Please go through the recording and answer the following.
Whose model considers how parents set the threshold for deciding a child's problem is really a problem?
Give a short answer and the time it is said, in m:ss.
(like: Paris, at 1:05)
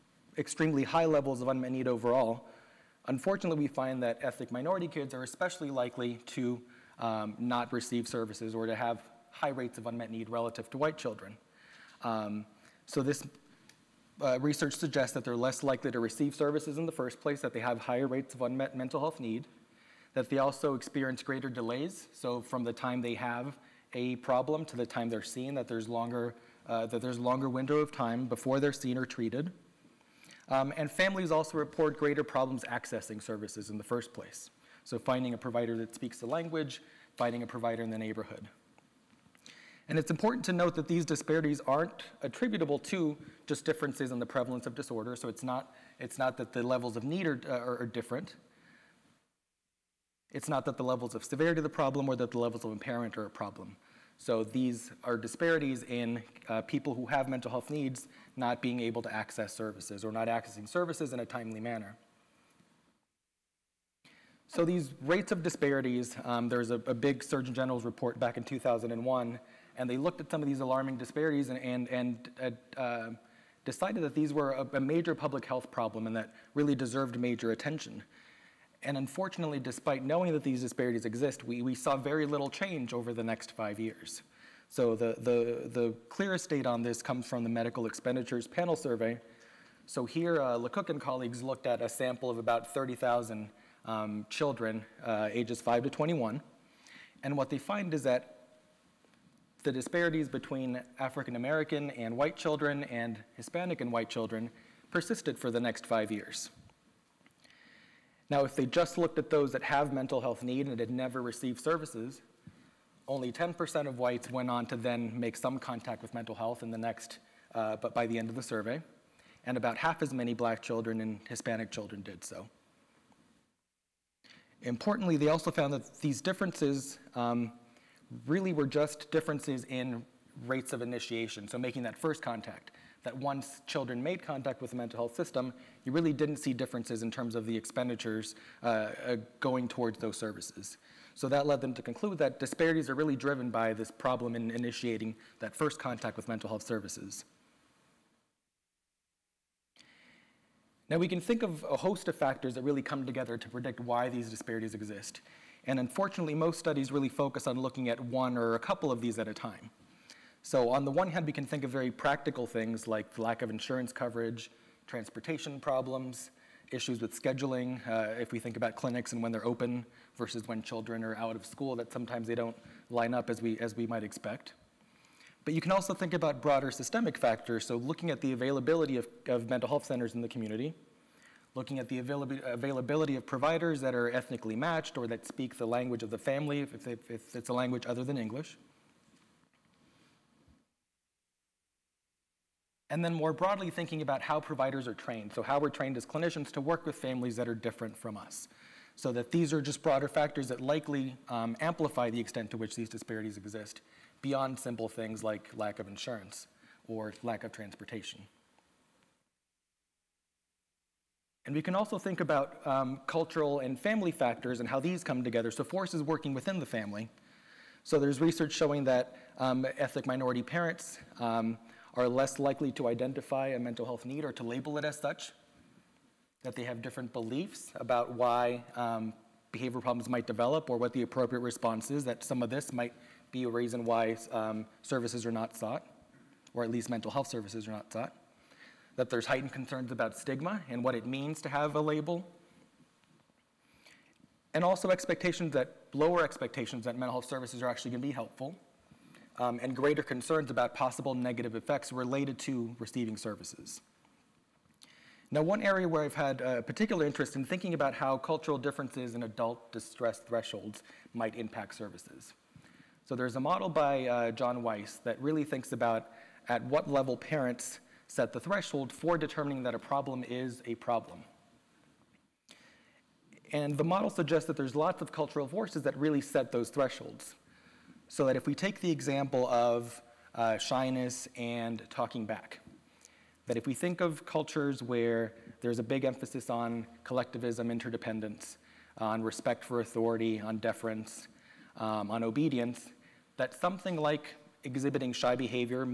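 John Weisz, at 4:24.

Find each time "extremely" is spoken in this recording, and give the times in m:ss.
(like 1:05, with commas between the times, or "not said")
0:00.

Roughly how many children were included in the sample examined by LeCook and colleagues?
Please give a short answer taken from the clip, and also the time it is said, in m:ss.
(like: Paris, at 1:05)
30,000, at 1:32.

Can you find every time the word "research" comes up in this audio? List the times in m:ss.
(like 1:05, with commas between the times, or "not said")
0:14, 3:38.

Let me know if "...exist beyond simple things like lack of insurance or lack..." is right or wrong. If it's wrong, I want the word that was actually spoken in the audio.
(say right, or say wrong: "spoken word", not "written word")
right.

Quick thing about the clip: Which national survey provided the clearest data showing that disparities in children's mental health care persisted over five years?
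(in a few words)
Medical Expenditures Panel Survey.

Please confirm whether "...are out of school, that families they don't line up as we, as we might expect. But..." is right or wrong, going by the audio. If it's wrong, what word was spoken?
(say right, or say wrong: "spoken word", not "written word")
wrong: "sometimes", not "families".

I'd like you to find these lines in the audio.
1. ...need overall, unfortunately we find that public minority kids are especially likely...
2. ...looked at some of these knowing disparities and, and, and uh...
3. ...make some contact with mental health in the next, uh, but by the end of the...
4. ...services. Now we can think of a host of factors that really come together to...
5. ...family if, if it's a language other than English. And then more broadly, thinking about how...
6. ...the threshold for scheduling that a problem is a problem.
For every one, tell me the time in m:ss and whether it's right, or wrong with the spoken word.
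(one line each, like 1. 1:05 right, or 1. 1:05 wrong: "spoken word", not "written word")
1. 0:01 wrong: "ethnic", not "public"
2. 1:09 wrong: "alarming", not "knowing"
3. 1:55 right
4. 2:26 right
5. 3:06 right
6. 4:28 wrong: "determining", not "scheduling".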